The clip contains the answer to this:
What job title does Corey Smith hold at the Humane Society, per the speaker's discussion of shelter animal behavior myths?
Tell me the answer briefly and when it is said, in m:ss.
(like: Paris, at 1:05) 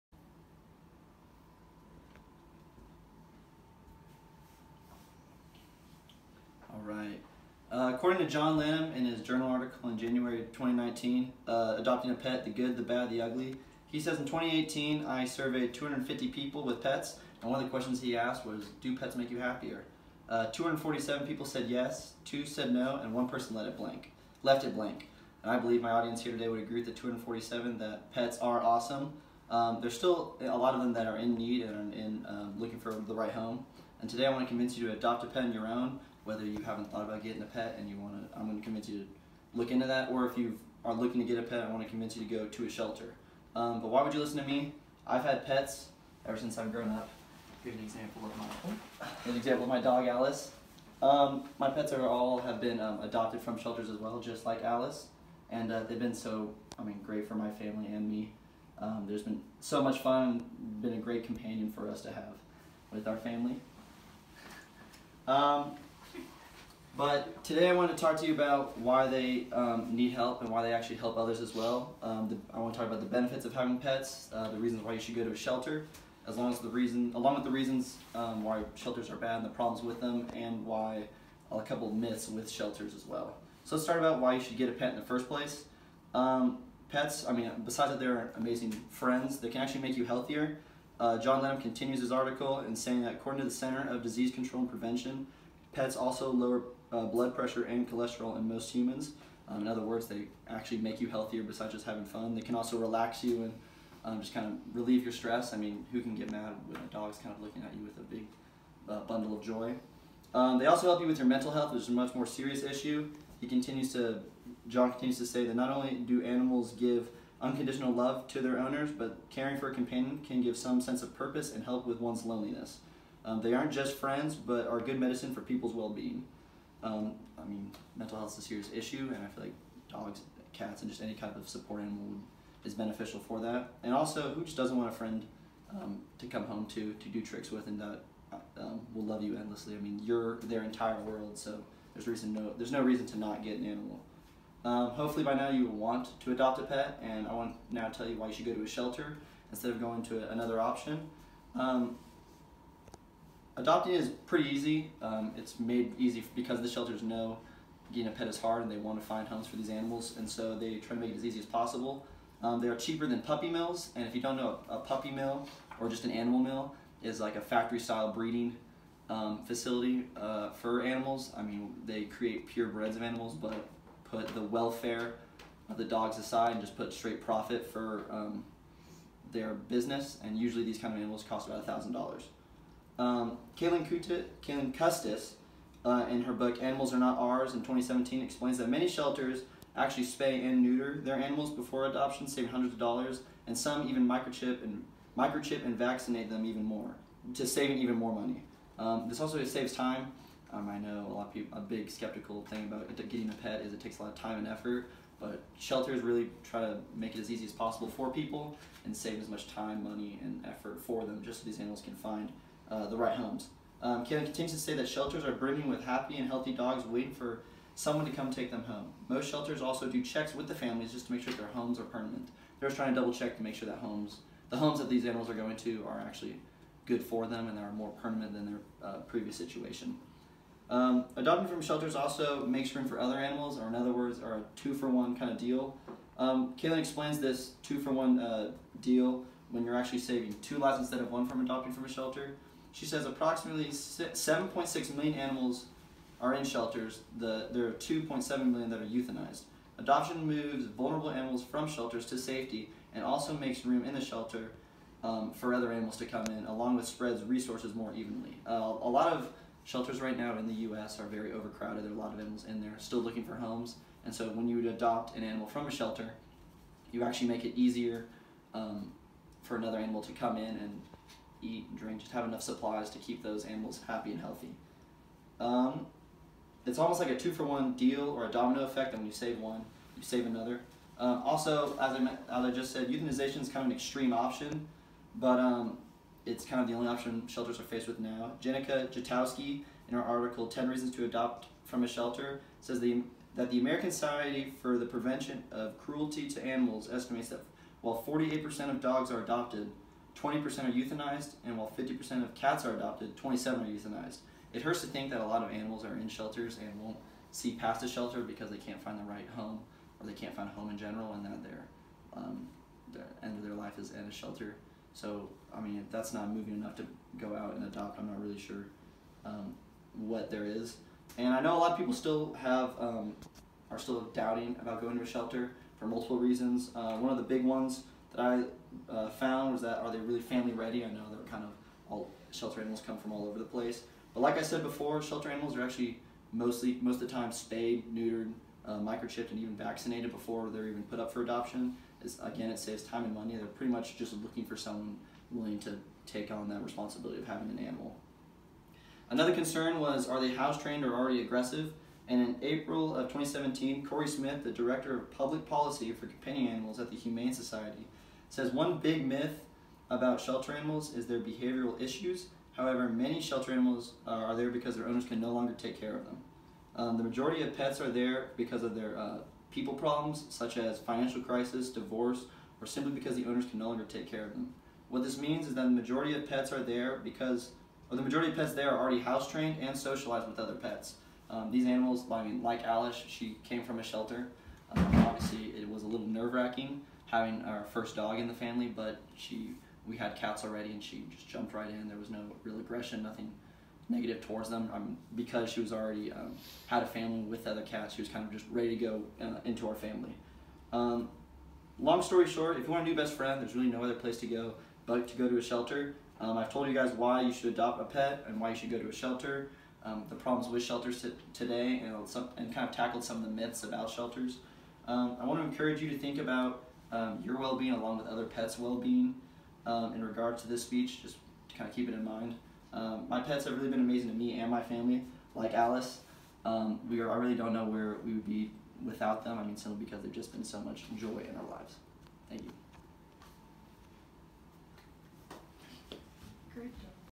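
Director of public policy for companion animals, at 5:54.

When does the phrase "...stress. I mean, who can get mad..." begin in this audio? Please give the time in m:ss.
1:45.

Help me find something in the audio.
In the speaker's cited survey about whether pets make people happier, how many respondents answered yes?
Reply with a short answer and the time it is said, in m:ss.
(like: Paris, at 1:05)
247, at 0:20.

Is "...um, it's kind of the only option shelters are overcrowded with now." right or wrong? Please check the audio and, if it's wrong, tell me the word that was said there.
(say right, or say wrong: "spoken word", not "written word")
wrong: "faced", not "overcrowded".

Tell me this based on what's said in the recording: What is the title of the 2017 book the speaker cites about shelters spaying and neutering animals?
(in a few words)
Animals Are Not Ours.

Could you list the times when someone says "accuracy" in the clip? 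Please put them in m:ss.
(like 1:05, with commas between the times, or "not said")
not said.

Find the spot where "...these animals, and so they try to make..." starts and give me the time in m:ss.
2:39.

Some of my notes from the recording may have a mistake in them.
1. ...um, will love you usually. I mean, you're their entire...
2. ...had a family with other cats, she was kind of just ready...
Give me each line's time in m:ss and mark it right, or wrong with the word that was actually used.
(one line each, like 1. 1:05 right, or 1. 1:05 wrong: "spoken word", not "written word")
1. 2:18 wrong: "endlessly", not "usually"
2. 6:36 right.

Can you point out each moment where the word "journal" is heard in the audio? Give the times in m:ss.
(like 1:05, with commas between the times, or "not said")
0:09.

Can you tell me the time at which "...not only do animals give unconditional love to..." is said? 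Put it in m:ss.
1:55.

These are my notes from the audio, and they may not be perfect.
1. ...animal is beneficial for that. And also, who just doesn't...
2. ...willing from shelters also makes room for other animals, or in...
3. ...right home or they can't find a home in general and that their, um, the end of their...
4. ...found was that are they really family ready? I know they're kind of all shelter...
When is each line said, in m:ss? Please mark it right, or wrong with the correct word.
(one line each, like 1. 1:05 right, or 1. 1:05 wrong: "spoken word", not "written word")
1. 2:11 right
2. 3:51 wrong: "adopting", not "willing"
3. 5:09 right
4. 5:29 right.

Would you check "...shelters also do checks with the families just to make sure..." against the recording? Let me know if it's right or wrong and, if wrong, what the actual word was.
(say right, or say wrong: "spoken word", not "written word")
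right.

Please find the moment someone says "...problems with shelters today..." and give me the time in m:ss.
6:50.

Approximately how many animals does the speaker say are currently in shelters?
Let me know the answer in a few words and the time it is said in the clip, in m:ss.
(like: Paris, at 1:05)
7.6 million, at 4:03.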